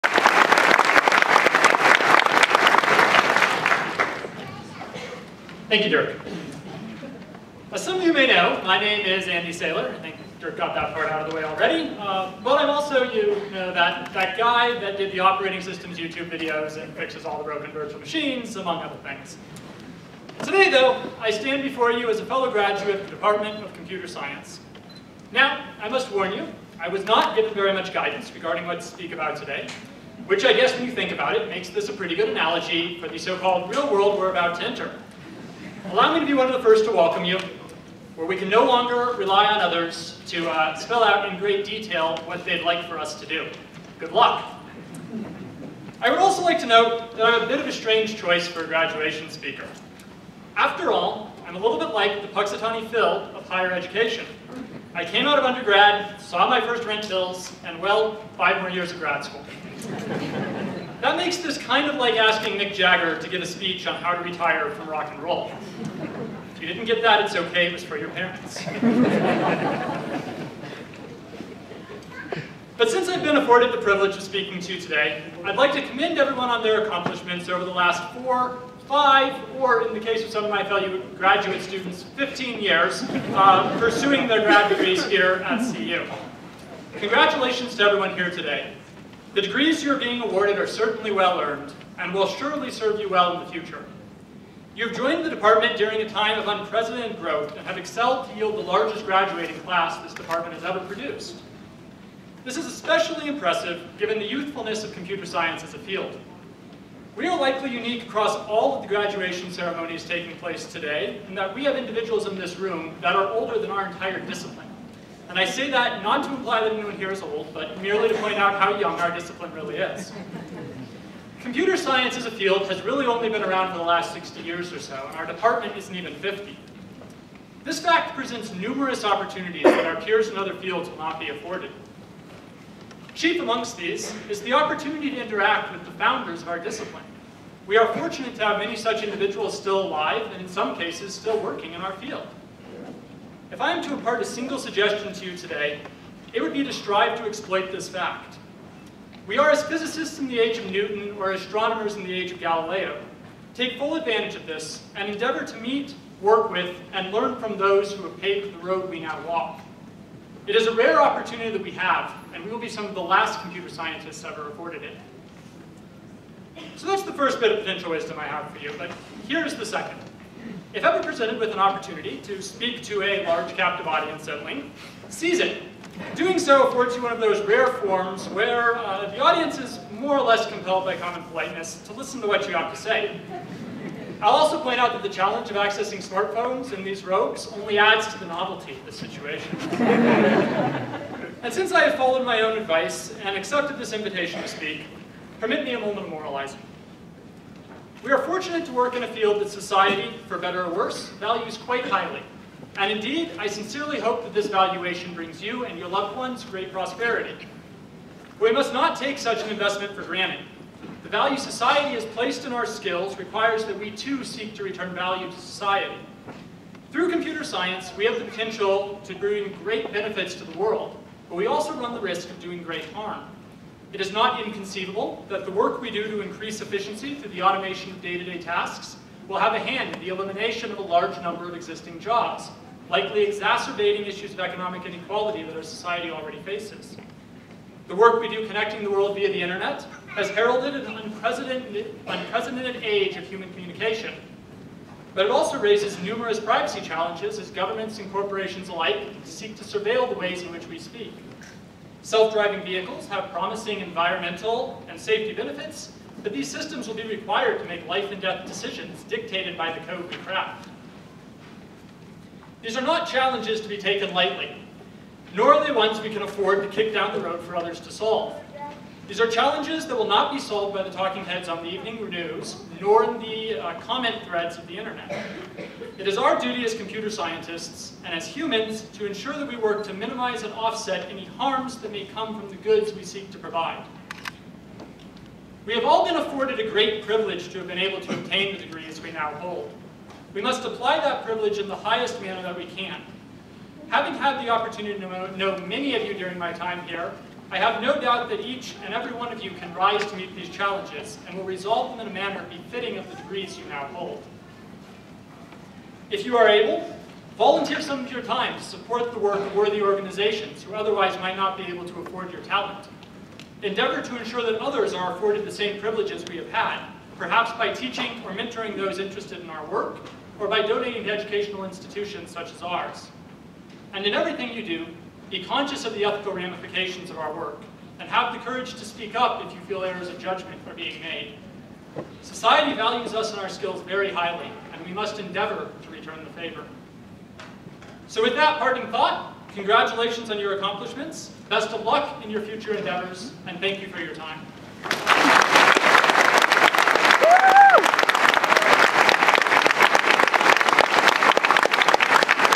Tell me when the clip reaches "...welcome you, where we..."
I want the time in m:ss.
0:36.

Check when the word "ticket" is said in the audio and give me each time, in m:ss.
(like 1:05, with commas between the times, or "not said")
not said.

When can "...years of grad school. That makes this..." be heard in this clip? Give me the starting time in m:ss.
0:58.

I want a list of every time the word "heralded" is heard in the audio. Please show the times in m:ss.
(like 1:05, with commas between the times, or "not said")
4:00.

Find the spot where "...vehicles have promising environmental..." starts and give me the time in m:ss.
4:12.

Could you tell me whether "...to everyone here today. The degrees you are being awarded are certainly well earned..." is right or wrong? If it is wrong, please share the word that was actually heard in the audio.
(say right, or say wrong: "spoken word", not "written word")
right.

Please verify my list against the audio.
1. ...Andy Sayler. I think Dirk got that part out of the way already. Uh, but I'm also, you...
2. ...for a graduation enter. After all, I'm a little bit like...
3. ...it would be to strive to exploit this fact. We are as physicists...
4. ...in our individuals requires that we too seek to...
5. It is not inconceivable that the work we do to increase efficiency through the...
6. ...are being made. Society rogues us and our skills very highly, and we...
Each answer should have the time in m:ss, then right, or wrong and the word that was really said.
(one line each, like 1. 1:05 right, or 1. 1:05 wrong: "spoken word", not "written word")
1. 0:09 right
2. 0:48 wrong: "speaker", not "enter"
3. 2:26 right
4. 3:32 wrong: "skills", not "individuals"
5. 3:43 right
6. 5:30 wrong: "values", not "rogues".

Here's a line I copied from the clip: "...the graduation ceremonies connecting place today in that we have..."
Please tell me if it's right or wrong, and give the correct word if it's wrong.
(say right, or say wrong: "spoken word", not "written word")
wrong: "taking", not "connecting".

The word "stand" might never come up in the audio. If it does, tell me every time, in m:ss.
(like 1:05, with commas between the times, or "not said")
0:21.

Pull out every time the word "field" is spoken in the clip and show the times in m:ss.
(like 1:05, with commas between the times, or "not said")
1:45, 2:02, 2:10, 2:21, 3:19.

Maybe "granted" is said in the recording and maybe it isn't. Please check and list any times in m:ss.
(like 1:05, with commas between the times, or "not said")
3:30.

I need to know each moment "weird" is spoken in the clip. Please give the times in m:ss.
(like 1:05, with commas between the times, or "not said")
not said.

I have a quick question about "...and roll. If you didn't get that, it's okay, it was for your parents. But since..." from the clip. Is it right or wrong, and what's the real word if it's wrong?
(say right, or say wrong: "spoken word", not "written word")
right.